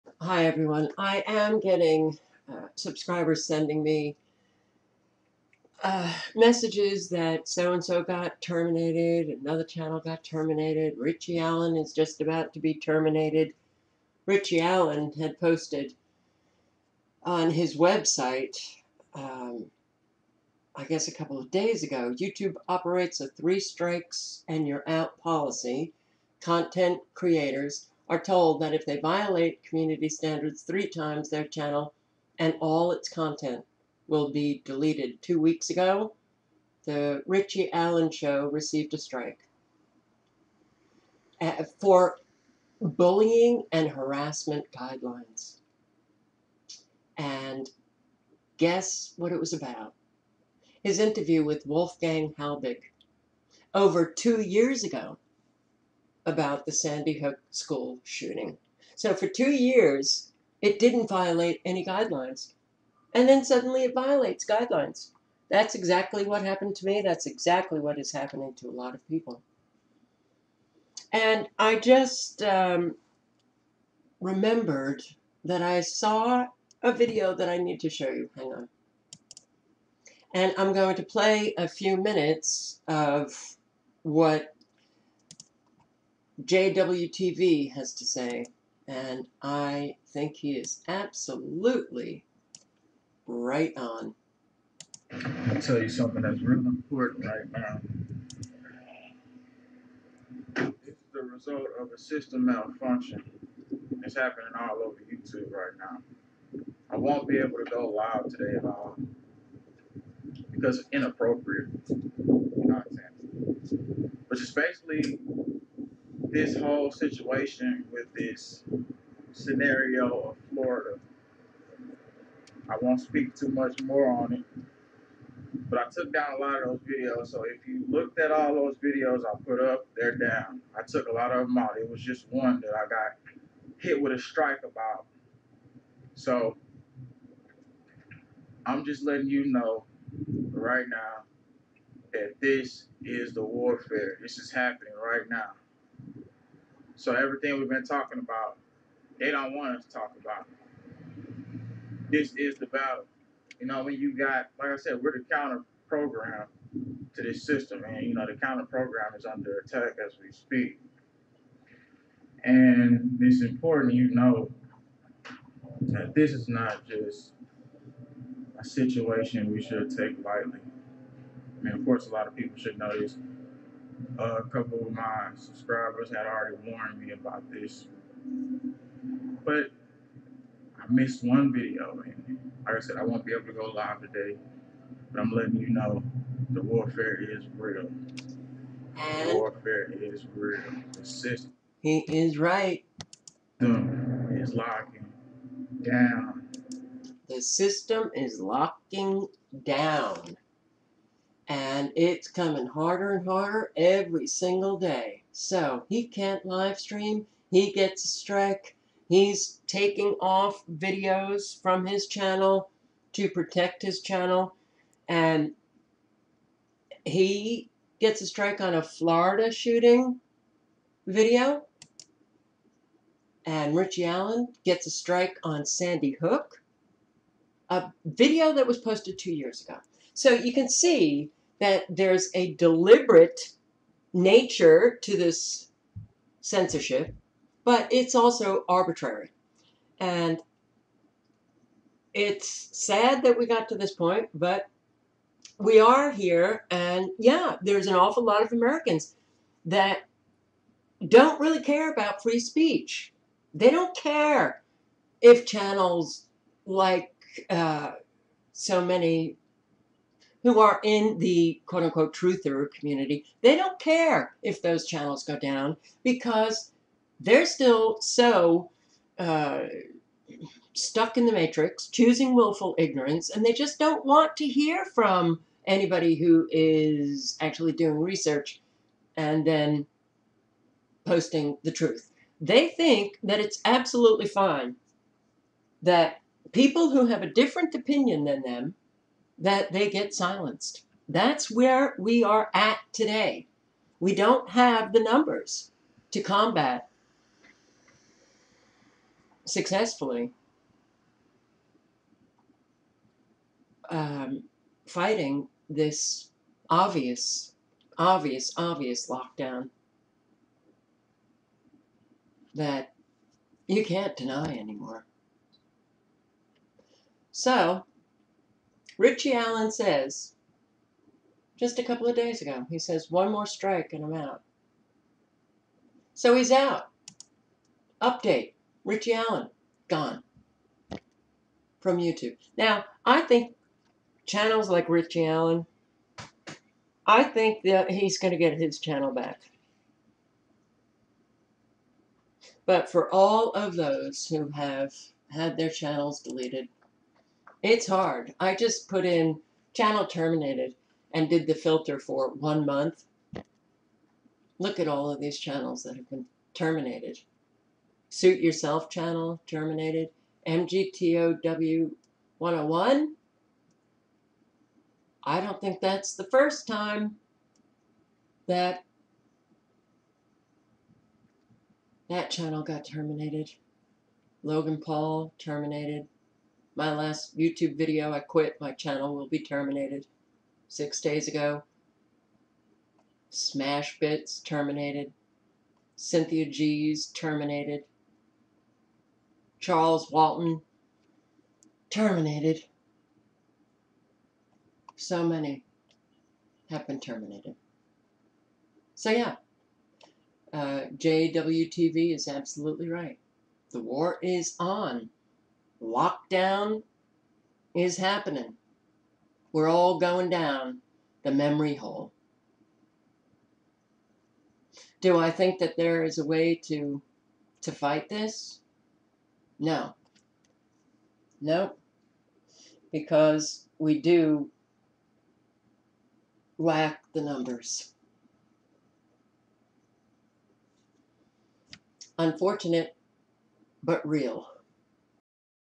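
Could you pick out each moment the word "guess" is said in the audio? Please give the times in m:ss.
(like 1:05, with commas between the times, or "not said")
0:20, 0:48.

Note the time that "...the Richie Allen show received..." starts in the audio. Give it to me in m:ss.
0:36.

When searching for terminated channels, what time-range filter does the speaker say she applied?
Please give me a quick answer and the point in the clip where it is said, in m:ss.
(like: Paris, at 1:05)
one month, at 5:52.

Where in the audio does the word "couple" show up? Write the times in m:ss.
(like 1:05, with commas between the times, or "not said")
0:21, 2:54, 5:21.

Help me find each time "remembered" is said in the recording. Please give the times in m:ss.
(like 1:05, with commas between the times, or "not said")
1:14.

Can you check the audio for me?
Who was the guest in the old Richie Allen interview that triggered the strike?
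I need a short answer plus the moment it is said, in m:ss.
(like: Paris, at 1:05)
Wolfgang Halbig, at 0:51.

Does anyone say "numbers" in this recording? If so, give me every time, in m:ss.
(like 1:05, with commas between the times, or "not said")
4:55, 7:07.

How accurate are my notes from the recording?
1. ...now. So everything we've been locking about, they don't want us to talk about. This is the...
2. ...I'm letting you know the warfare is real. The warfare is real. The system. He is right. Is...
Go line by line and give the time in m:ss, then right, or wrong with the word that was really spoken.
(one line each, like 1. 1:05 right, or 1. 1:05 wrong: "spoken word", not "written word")
1. 2:25 wrong: "talking", not "locking"
2. 3:05 right.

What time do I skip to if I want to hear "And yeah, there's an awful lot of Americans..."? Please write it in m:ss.
4:06.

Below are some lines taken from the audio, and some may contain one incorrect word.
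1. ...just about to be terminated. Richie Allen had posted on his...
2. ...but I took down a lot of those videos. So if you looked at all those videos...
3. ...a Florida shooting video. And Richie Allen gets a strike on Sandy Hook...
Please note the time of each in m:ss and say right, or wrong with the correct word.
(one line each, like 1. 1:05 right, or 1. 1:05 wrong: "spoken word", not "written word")
1. 0:11 right
2. 2:05 right
3. 3:38 right.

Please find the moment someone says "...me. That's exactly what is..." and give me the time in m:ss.
1:06.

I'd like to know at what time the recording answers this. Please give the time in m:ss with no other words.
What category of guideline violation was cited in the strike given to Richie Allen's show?
0:42.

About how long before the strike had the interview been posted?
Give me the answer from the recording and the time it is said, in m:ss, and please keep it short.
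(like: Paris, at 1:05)
over two years, at 0:53.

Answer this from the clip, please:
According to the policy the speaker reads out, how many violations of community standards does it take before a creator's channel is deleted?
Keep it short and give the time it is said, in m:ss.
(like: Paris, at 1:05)
3, at 0:30.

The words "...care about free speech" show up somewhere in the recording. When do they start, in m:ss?
4:11.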